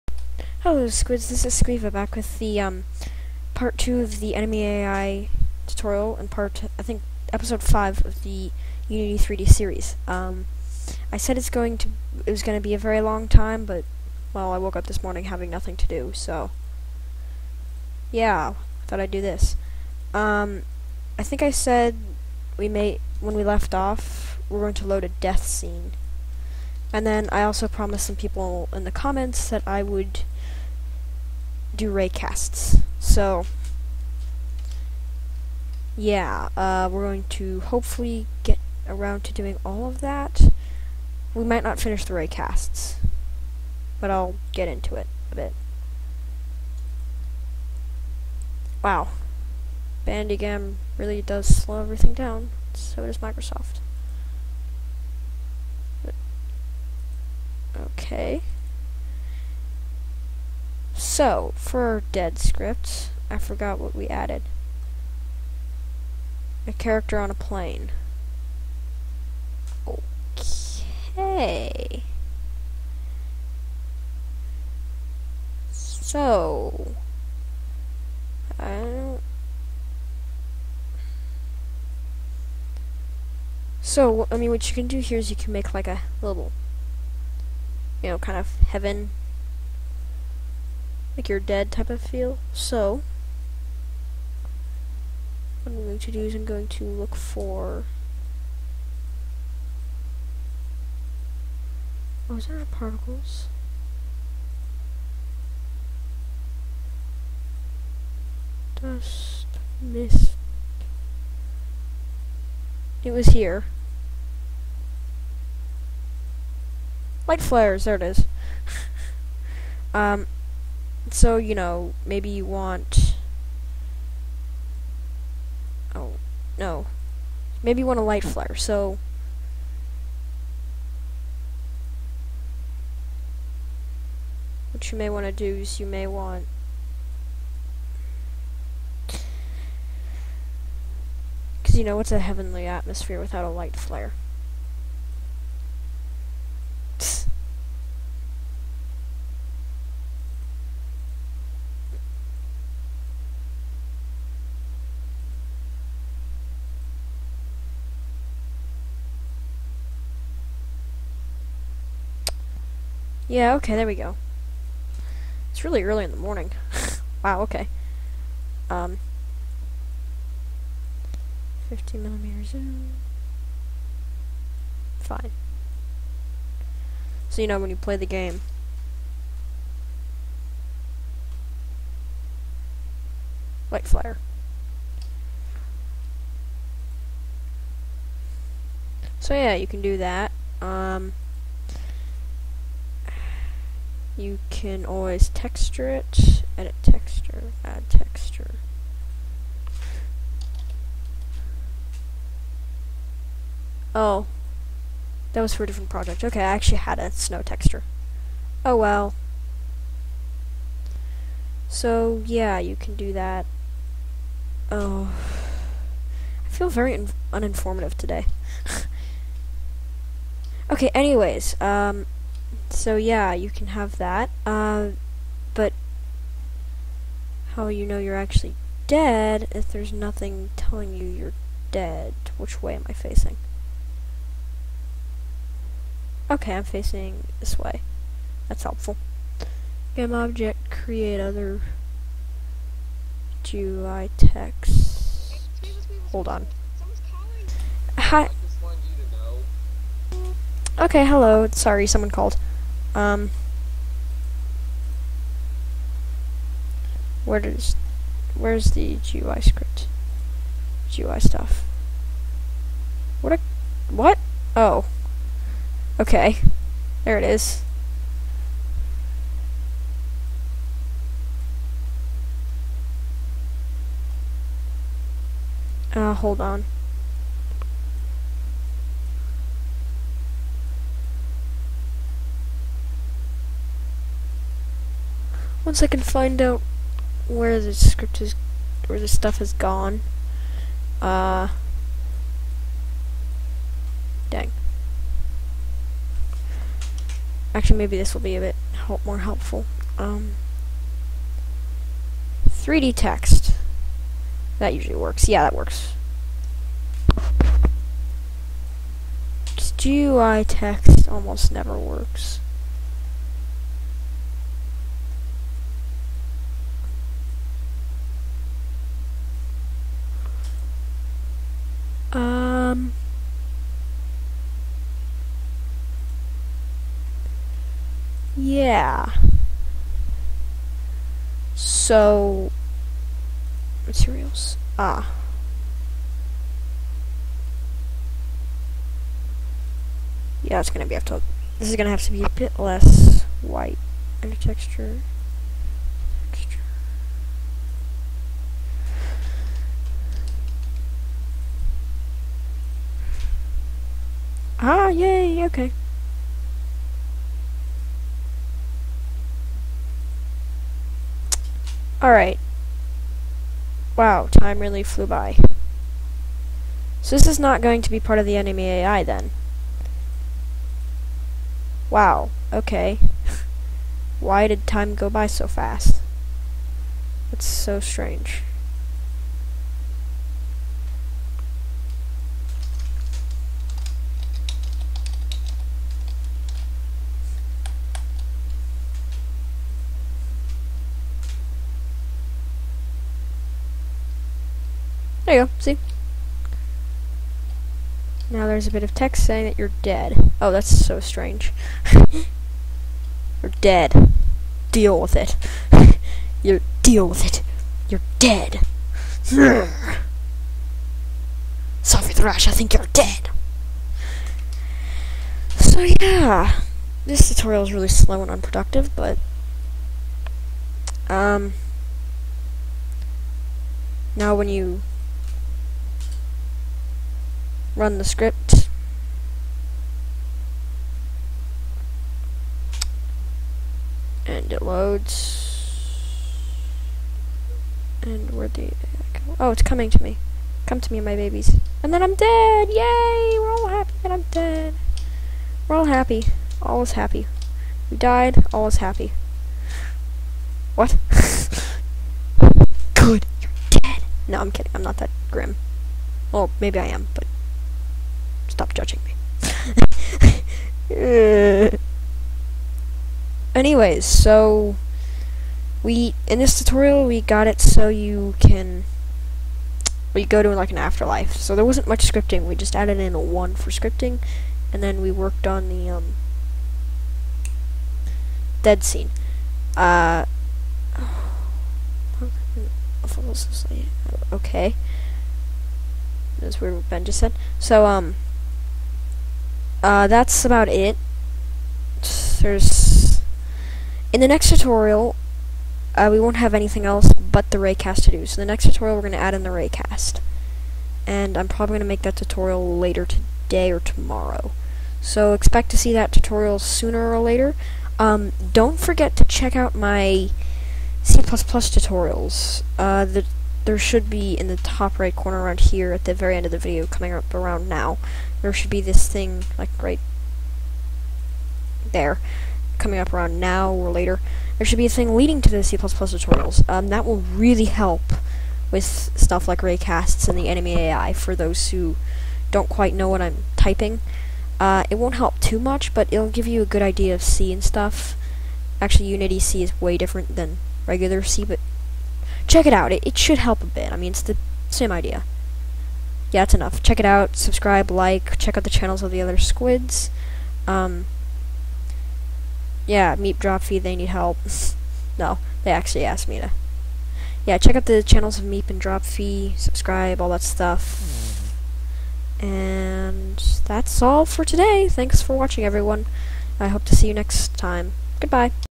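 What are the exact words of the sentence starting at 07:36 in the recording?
Well, maybe I am, but stop judging me.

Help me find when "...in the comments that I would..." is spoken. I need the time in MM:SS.
00:28.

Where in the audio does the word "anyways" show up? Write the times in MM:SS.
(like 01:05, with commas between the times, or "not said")
03:40, 07:43.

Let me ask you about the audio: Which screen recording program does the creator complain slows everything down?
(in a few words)
Bandicam.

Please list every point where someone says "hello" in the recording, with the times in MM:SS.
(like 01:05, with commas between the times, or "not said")
00:00, 04:11.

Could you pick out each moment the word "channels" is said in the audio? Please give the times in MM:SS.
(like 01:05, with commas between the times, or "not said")
09:08, 09:18.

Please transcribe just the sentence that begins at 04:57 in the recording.
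Actually, maybe this will be a bit help more helpful.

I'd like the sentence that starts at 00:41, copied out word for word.
We might not finish the raycasts, but I'll get into it a bit.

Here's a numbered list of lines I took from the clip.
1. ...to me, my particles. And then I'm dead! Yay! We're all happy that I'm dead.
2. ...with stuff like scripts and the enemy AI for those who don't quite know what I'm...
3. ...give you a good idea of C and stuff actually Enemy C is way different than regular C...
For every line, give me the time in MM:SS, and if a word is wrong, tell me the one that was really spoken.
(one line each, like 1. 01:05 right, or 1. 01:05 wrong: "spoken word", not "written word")
1. 07:20 wrong: "babies", not "particles"
2. 08:48 wrong: "raycasts", not "scripts"
3. 08:56 wrong: "Unity", not "Enemy".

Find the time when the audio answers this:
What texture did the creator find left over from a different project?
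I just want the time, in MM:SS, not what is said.
03:27.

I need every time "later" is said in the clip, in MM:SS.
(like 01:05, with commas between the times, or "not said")
08:22, 08:27, 08:43.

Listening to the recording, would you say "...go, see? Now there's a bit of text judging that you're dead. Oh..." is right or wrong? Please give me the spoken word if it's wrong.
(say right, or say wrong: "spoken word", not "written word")
wrong: "saying", not "judging".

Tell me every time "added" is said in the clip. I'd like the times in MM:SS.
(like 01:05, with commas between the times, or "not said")
01:04, 07:52.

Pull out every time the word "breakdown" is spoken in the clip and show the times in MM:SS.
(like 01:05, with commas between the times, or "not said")
not said.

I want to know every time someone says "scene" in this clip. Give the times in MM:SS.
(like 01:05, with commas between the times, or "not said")
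00:25, 07:58.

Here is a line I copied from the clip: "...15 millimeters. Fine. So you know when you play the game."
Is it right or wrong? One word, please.
right.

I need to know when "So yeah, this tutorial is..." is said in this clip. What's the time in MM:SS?
06:55.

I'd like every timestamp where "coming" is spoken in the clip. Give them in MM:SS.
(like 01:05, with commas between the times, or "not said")
07:19, 08:36, 08:42.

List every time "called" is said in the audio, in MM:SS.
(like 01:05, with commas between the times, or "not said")
04:12.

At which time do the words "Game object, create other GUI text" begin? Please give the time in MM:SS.
03:59.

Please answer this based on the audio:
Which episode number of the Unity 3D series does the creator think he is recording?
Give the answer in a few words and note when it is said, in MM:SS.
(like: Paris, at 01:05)
5, at 00:07.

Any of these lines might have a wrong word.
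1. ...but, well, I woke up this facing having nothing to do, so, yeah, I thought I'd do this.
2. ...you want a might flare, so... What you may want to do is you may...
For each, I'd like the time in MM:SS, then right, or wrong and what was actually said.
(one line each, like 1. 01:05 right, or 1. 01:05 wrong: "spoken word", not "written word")
1. 00:13 wrong: "morning", not "facing"
2. 02:07 wrong: "light", not "might".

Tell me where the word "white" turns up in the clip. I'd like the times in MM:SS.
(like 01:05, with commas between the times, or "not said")
05:43.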